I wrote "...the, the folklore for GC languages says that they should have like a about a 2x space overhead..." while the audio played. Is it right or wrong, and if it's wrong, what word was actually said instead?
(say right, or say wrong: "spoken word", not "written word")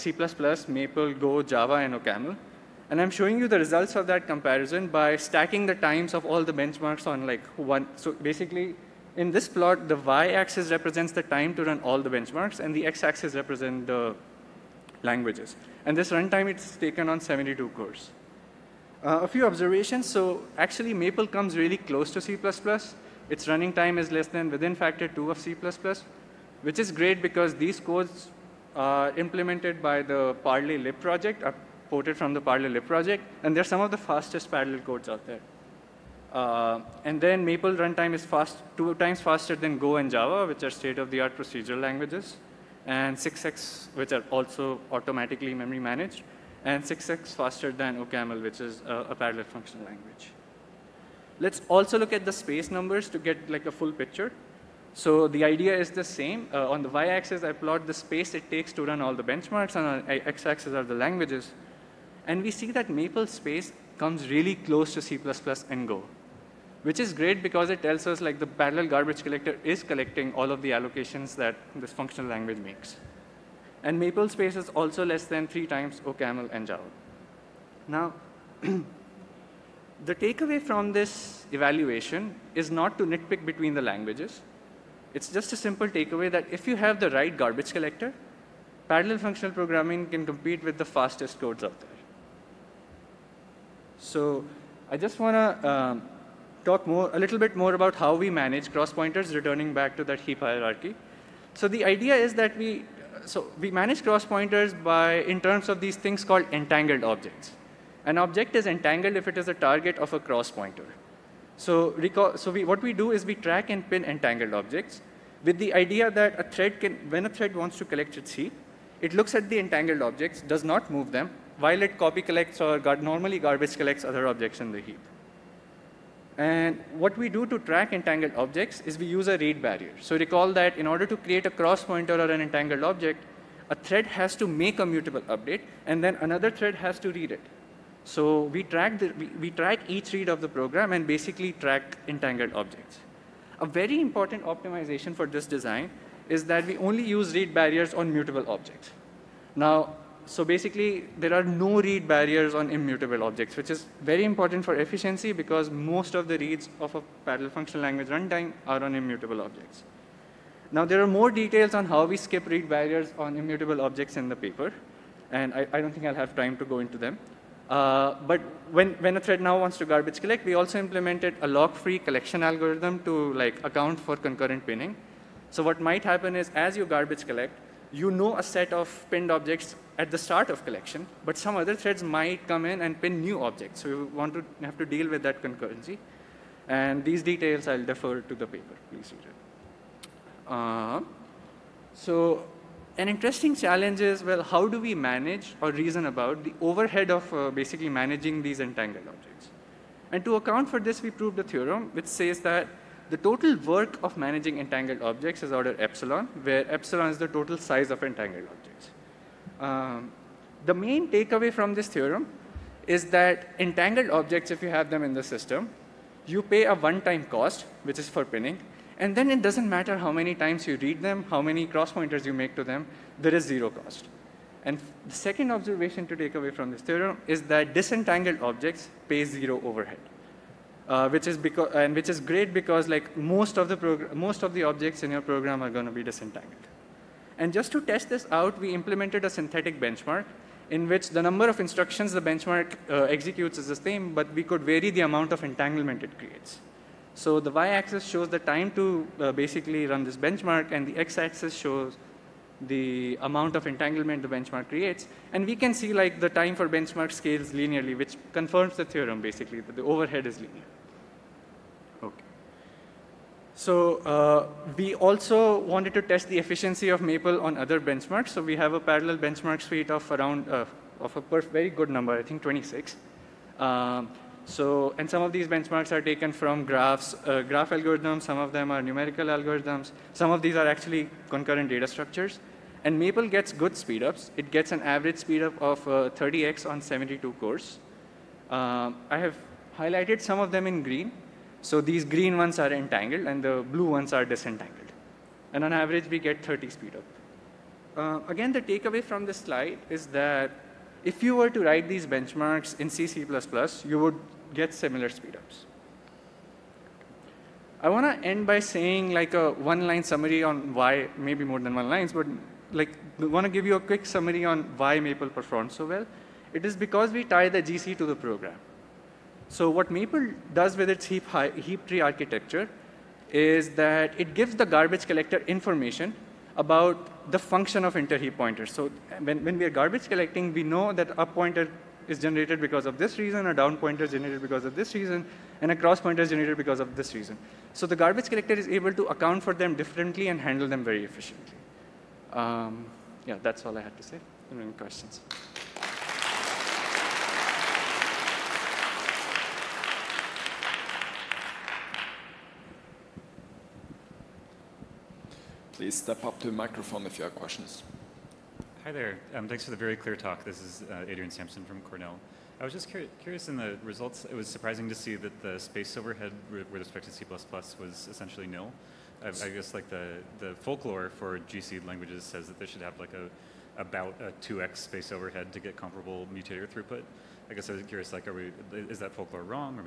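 right.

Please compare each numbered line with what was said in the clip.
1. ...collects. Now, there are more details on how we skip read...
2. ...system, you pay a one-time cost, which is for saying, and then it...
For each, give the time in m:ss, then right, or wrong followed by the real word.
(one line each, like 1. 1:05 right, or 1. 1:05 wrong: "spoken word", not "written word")
1. 2:39 wrong: "objects", not "collects"
2. 3:35 wrong: "pinning", not "saying".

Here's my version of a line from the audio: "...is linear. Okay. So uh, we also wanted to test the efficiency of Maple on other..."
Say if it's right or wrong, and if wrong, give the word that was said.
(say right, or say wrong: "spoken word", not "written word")
right.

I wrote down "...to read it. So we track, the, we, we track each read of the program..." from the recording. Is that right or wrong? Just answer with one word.
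right.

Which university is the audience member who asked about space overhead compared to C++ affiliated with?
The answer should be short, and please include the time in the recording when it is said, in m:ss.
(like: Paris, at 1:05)
Cornell, at 6:01.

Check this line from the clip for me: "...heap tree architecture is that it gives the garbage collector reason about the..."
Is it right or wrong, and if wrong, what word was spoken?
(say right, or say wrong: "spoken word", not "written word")
wrong: "information", not "reason".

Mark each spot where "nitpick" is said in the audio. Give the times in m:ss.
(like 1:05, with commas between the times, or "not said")
1:23.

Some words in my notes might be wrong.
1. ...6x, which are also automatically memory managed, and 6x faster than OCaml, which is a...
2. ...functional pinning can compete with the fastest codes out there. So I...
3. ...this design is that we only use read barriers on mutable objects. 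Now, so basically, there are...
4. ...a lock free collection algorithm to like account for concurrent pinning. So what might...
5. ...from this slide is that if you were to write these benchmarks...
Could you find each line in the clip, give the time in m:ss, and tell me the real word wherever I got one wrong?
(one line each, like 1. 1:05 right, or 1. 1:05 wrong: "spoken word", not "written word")
1. 0:43 right
2. 1:29 wrong: "programming", not "pinning"
3. 2:25 right
4. 2:51 right
5. 4:59 right.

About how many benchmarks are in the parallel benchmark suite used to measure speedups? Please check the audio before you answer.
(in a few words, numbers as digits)
26.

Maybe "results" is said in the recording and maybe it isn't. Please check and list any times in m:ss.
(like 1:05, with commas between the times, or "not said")
0:03, 6:03.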